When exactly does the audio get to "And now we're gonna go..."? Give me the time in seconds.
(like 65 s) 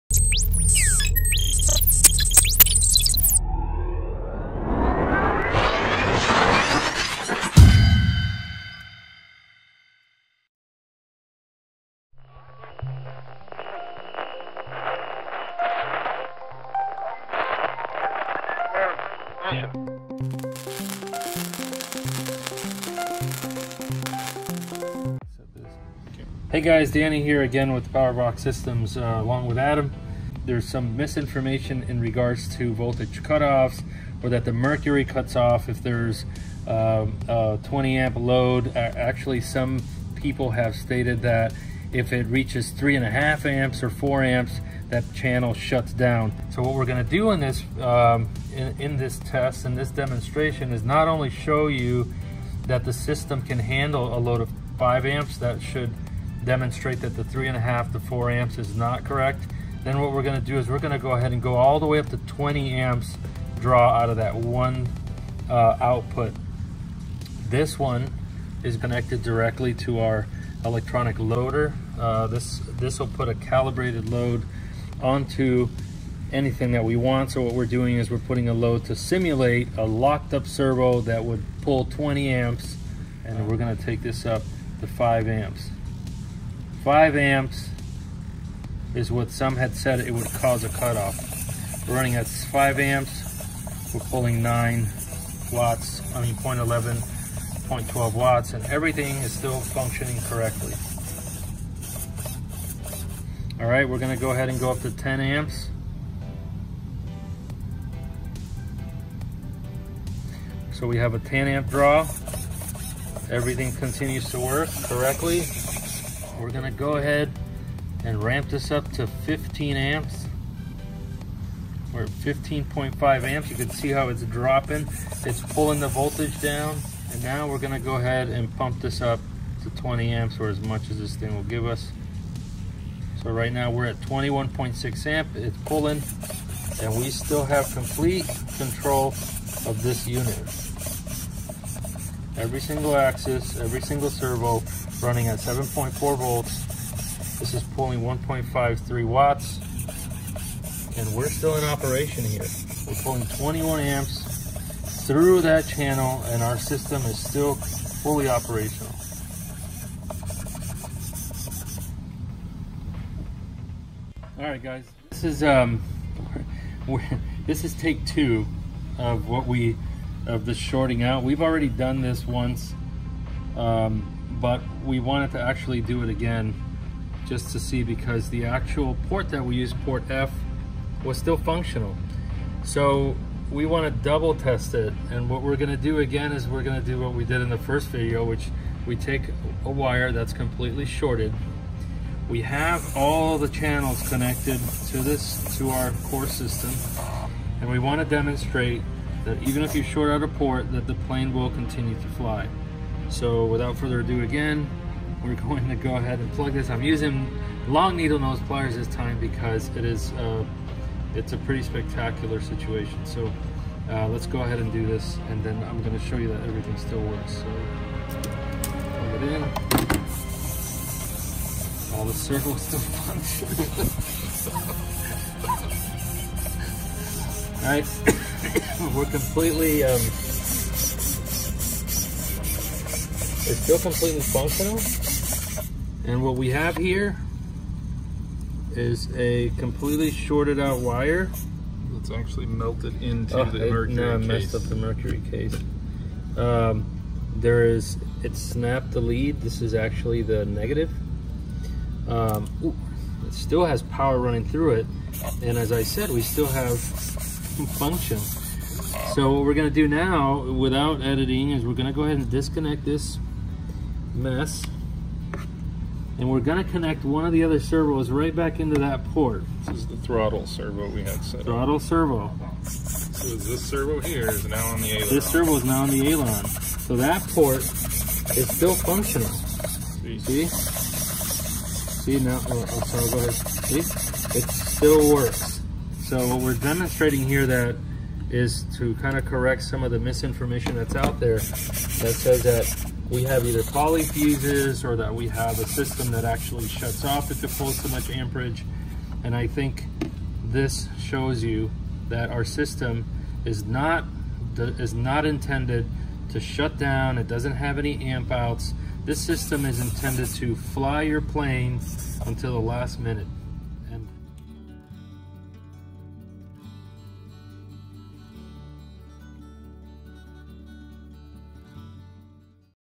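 127 s.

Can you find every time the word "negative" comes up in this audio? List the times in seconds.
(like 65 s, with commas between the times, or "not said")
250 s.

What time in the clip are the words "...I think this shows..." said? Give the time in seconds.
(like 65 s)
299 s.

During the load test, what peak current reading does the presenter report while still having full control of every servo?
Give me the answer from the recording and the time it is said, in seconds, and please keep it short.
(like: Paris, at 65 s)
21.6 amps, at 133 s.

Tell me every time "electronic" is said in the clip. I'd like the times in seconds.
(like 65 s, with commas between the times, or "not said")
70 s.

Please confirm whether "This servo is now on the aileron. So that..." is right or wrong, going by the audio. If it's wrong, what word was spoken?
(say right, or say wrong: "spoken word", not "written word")
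right.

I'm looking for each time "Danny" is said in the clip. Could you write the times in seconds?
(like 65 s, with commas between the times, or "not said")
26 s.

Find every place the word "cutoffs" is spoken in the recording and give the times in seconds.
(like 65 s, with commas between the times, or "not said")
33 s, 90 s.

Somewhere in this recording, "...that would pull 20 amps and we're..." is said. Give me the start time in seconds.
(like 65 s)
81 s.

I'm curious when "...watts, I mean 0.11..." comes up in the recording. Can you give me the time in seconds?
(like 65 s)
95 s.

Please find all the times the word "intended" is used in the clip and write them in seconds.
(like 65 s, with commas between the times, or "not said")
305 s, 309 s.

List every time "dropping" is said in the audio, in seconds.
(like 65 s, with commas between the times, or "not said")
124 s.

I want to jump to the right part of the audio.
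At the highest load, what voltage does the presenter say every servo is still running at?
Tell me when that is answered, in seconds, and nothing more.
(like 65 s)
145 s.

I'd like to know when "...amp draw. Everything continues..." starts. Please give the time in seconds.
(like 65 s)
111 s.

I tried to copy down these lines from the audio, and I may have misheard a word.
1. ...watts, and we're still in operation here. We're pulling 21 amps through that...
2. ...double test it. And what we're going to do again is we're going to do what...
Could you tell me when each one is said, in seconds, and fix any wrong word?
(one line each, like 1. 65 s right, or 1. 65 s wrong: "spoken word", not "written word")
1. 149 s right
2. 184 s right.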